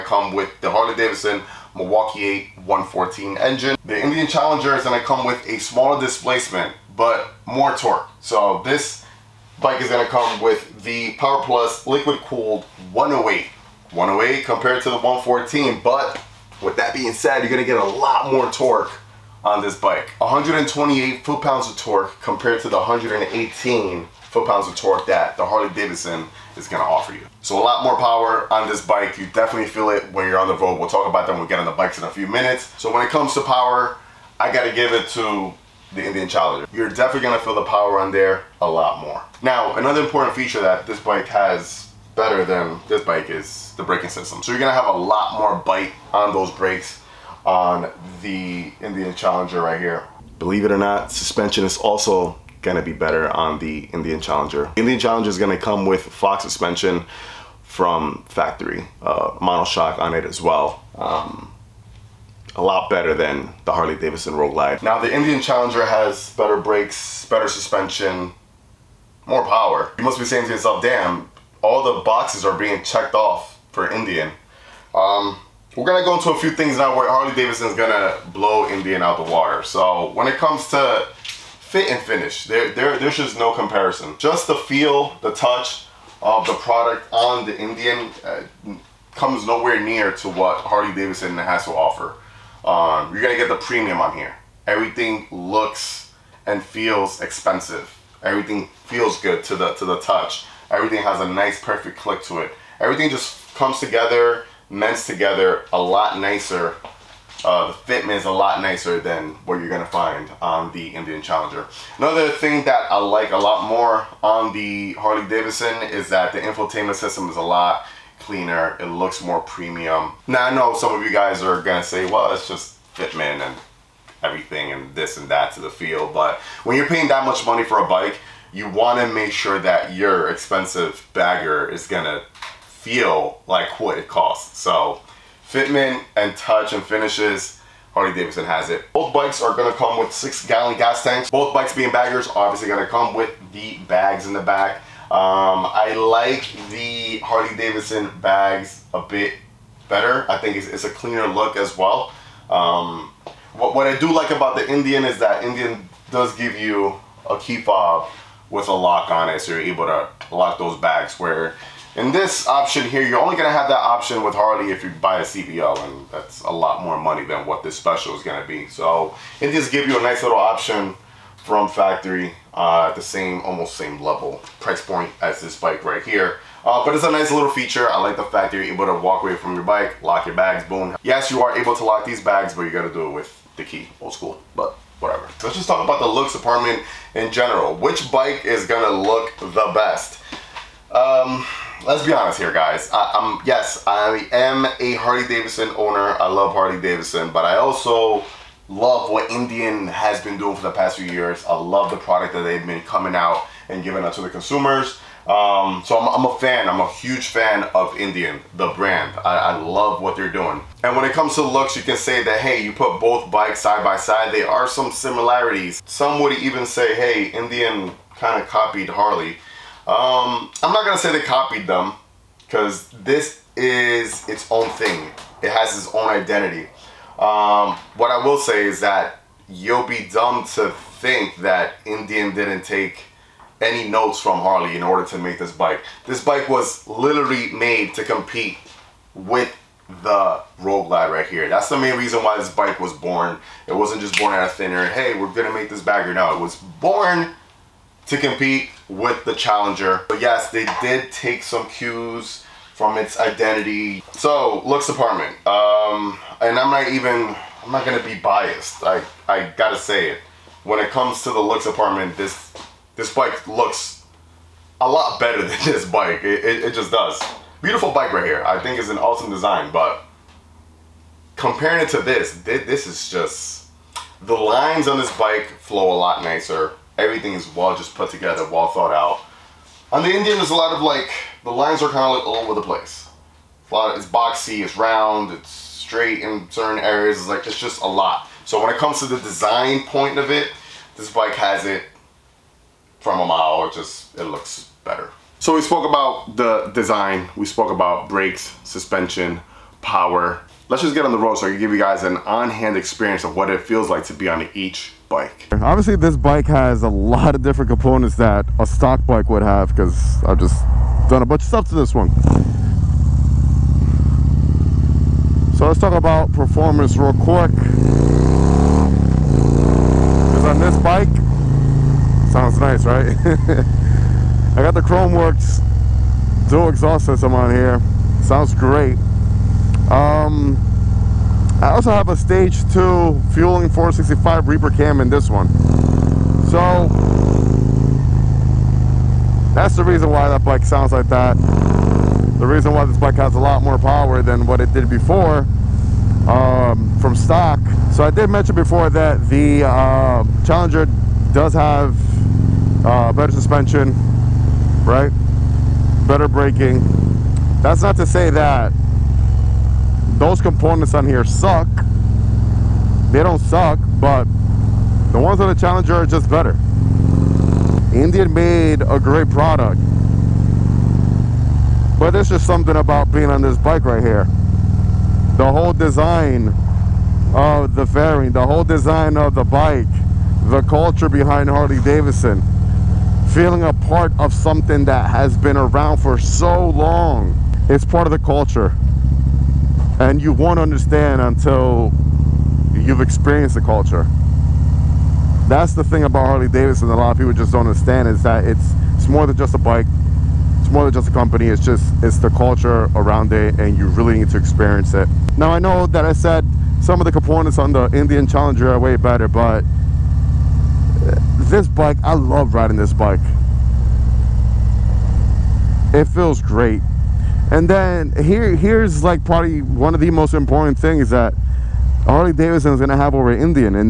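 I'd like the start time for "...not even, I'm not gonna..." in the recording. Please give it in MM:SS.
04:16.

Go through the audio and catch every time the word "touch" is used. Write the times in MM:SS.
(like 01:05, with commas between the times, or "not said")
01:25, 01:39, 02:16.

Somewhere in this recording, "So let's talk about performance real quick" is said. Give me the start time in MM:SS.
05:15.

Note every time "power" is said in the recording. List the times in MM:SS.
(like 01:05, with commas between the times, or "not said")
00:11, 00:27, 00:33, 00:37, 01:09, 04:59, 05:43.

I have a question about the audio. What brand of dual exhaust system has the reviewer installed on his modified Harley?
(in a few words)
Khrome Werks.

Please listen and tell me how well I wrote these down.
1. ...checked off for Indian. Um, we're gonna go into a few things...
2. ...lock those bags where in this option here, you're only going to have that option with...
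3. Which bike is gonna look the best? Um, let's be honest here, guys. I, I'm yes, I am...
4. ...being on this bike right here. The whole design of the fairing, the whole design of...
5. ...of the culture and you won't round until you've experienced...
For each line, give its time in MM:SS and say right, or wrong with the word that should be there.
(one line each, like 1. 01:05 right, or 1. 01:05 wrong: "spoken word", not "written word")
1. 01:12 right
2. 02:40 right
3. 03:07 right
4. 06:13 right
5. 06:28 wrong: "understand", not "round".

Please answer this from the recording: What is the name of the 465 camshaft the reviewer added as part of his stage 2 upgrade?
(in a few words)
Reaper.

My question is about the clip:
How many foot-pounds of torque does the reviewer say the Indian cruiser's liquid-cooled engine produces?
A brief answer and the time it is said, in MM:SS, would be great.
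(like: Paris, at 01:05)
128, at 00:20.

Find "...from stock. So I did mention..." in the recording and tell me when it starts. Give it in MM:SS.
05:46.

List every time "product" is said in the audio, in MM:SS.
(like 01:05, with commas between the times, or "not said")
01:26, 03:21, 06:09.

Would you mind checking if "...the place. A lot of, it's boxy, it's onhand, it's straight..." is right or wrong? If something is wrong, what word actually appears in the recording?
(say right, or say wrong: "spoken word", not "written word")
wrong: "round", not "onhand".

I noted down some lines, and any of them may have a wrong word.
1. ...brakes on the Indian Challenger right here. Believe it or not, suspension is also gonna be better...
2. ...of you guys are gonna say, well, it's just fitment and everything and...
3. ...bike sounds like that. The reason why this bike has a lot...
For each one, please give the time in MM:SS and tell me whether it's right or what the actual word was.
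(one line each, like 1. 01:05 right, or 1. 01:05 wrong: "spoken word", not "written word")
1. 00:46 right
2. 02:00 right
3. 05:40 right.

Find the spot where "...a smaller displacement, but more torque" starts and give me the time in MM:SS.
00:05.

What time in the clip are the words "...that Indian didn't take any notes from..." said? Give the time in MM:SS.
03:51.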